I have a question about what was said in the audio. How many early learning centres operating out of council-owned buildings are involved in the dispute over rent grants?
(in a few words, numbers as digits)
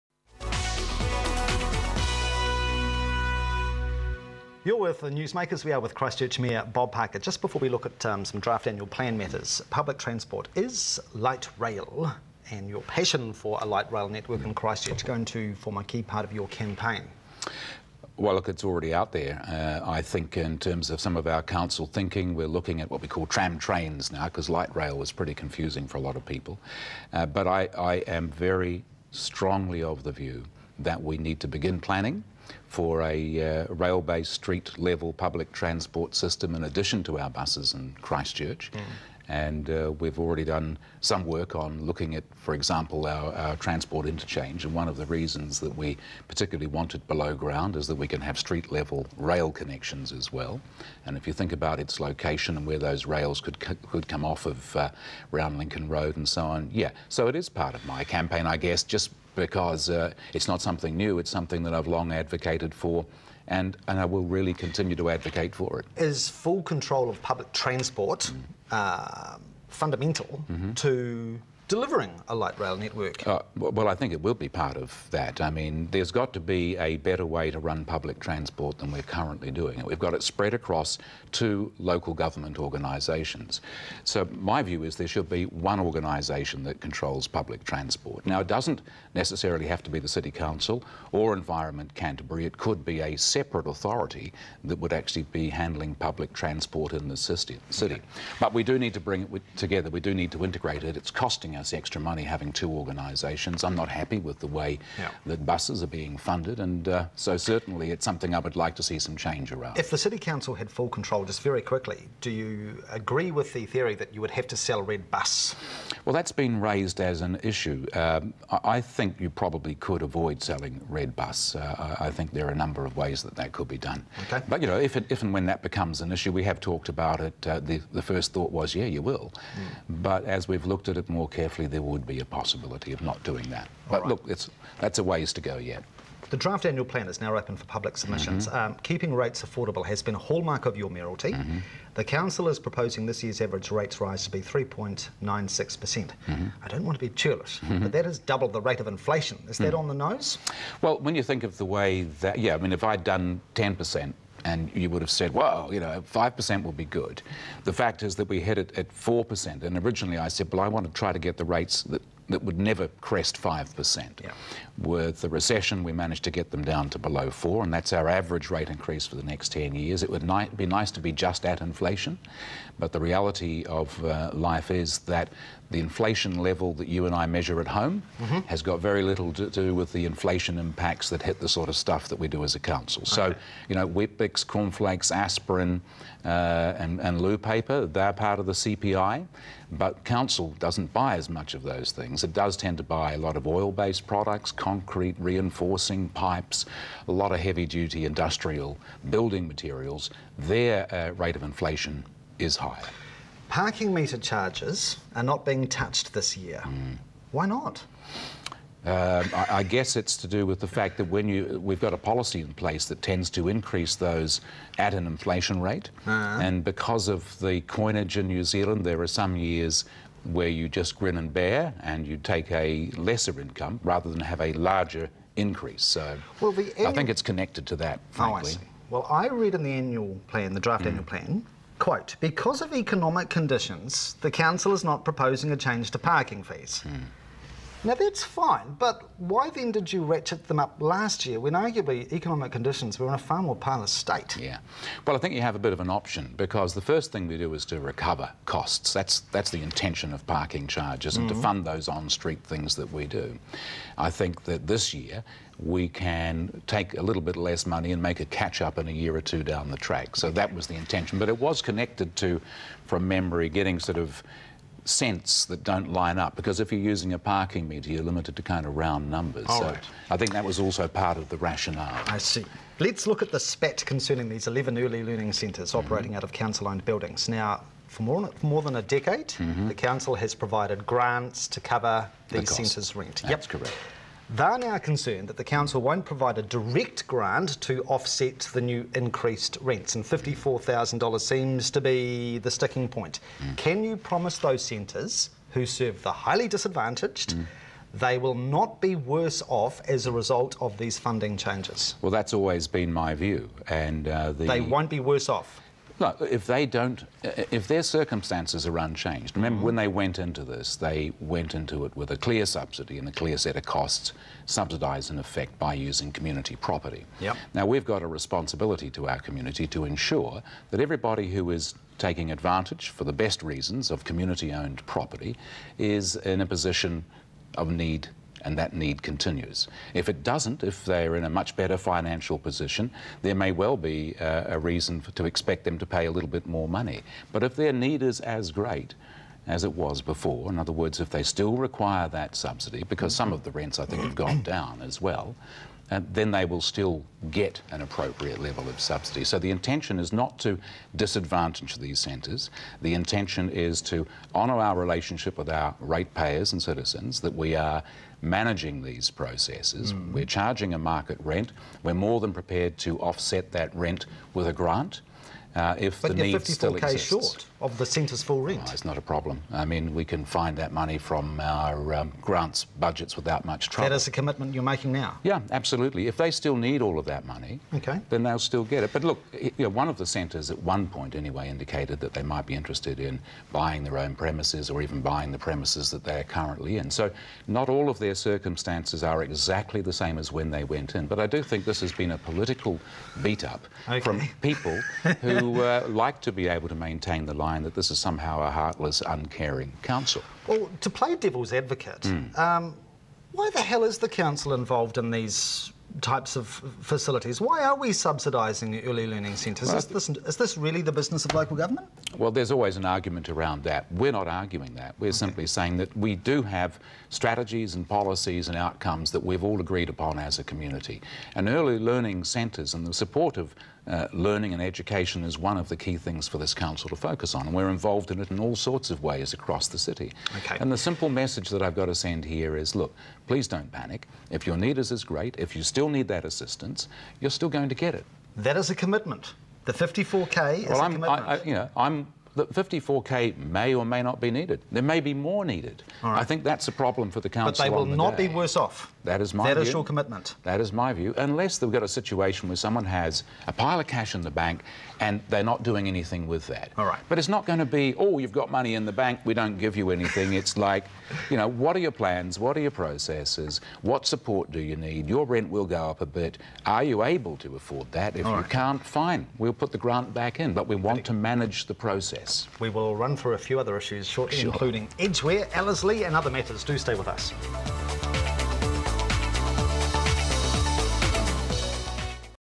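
11.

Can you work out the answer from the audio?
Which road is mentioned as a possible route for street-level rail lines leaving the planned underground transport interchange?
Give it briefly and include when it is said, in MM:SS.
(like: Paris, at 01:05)
Lincoln Road, at 00:55.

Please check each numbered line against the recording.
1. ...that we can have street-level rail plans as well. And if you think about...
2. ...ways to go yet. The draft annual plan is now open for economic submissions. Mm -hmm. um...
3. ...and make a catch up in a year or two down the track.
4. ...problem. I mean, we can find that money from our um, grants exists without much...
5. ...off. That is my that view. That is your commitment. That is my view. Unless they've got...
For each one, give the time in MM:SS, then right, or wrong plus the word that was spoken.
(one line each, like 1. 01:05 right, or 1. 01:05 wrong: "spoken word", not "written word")
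1. 00:47 wrong: "connections", not "plans"
2. 02:15 wrong: "public", not "economic"
3. 04:17 right
4. 06:09 wrong: "budgets", not "exists"
5. 07:28 right.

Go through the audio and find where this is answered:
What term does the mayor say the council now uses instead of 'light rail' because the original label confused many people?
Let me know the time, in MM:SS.
00:23.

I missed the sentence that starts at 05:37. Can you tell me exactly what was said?
But if their need is as great, as it was before.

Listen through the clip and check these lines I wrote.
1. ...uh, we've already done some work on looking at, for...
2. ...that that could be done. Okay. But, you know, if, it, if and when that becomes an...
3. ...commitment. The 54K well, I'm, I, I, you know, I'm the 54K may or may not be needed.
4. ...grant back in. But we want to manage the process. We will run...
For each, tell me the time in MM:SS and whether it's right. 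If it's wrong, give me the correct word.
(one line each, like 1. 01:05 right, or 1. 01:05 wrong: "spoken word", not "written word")
1. 00:39 right
2. 02:03 right
3. 07:18 right
4. 07:49 right.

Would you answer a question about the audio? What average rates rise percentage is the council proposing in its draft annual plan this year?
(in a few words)
3.96%.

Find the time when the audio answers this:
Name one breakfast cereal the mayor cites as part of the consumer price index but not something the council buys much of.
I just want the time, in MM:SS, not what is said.
03:03.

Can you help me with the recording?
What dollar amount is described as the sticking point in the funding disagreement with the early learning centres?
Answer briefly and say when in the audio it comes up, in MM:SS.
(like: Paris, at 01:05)
$54,000, at 04:50.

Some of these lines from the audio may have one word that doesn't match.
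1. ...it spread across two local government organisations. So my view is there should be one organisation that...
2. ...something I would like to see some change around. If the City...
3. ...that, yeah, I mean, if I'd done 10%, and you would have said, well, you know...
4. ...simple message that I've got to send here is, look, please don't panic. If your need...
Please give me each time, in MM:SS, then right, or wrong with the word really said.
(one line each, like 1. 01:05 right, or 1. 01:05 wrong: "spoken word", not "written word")
1. 01:20 right
2. 01:48 right
3. 02:32 right
4. 07:10 right.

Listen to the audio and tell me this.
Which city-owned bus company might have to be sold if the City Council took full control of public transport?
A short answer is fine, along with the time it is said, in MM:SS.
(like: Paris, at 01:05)
Red Bus, at 01:54.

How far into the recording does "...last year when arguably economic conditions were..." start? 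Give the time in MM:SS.
04:00.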